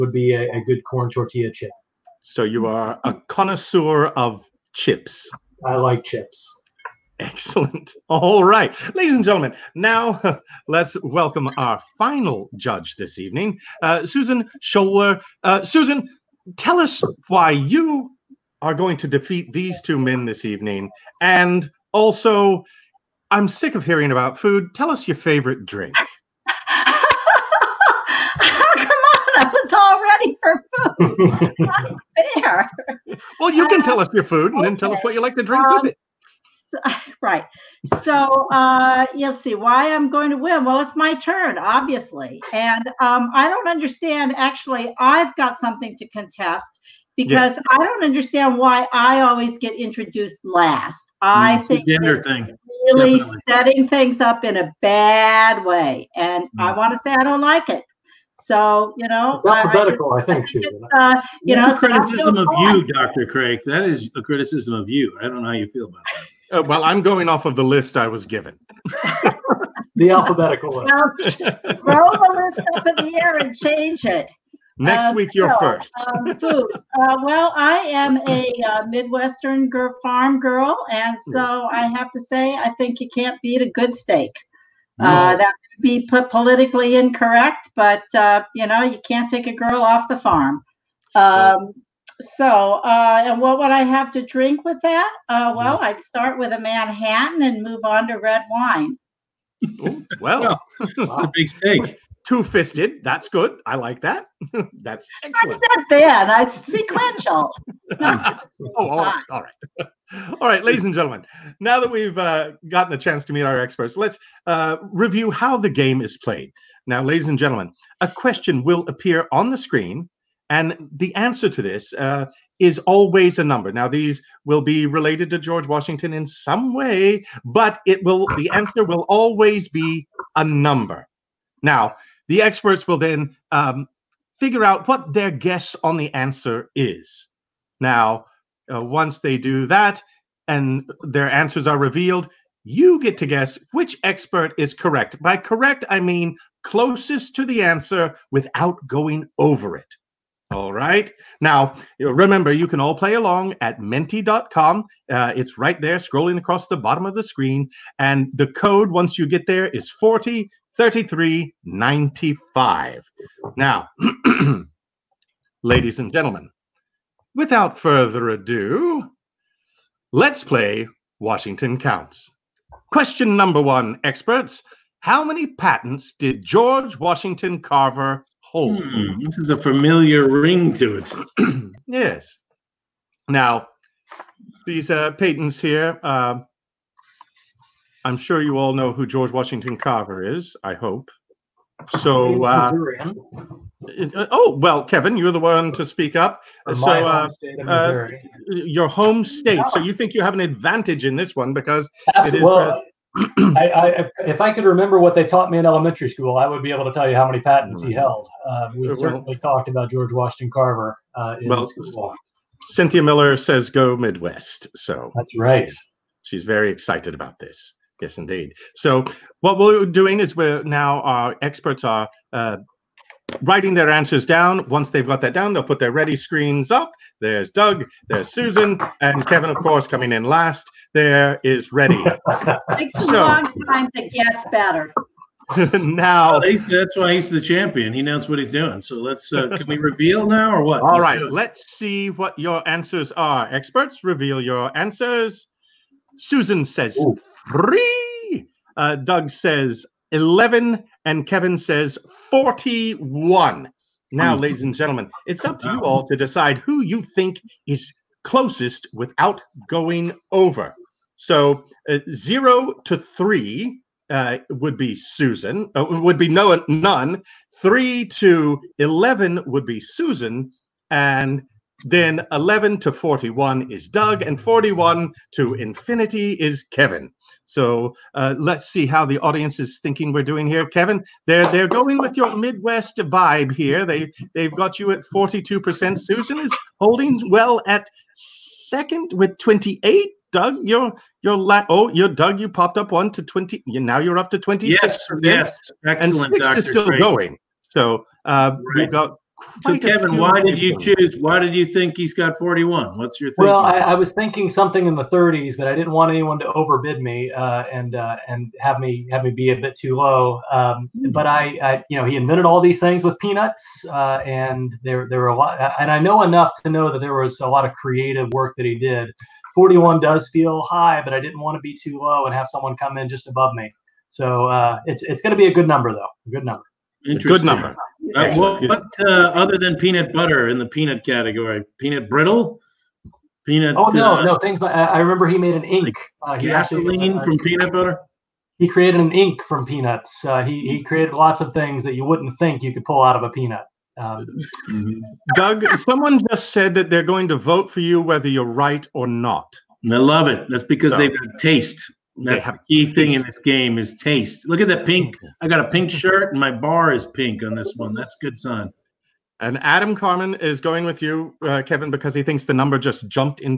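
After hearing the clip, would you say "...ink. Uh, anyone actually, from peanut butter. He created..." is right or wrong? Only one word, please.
wrong.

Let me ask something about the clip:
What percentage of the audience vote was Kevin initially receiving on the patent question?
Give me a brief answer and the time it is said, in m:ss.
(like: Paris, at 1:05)
42%, at 4:45.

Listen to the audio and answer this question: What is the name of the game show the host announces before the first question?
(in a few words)
Washington Counts.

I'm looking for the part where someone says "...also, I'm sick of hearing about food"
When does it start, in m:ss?
0:21.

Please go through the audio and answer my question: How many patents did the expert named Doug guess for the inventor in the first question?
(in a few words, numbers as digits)
11.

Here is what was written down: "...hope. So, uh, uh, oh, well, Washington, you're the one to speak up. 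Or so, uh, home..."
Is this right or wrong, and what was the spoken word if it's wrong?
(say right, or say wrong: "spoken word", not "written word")
wrong: "Kevin", not "Washington".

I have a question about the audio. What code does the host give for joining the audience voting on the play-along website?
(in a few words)
403395.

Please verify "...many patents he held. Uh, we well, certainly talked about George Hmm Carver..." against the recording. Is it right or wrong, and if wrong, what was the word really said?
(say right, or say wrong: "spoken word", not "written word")
wrong: "Washington", not "Hmm".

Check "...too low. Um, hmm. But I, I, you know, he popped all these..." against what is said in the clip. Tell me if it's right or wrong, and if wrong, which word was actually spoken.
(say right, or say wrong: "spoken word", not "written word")
wrong: "invented", not "popped".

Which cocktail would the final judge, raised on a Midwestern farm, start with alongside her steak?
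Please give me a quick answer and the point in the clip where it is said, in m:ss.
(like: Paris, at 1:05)
Manhattan, at 1:36.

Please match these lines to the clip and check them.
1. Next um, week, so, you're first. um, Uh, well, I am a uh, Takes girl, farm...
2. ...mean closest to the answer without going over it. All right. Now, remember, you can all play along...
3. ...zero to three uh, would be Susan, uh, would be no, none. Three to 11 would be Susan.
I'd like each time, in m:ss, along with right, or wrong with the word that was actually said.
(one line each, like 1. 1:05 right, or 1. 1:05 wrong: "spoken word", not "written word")
1. 1:14 wrong: "Midwestern", not "Takes"
2. 2:25 right
3. 4:22 right.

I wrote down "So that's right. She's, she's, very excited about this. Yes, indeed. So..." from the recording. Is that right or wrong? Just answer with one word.
right.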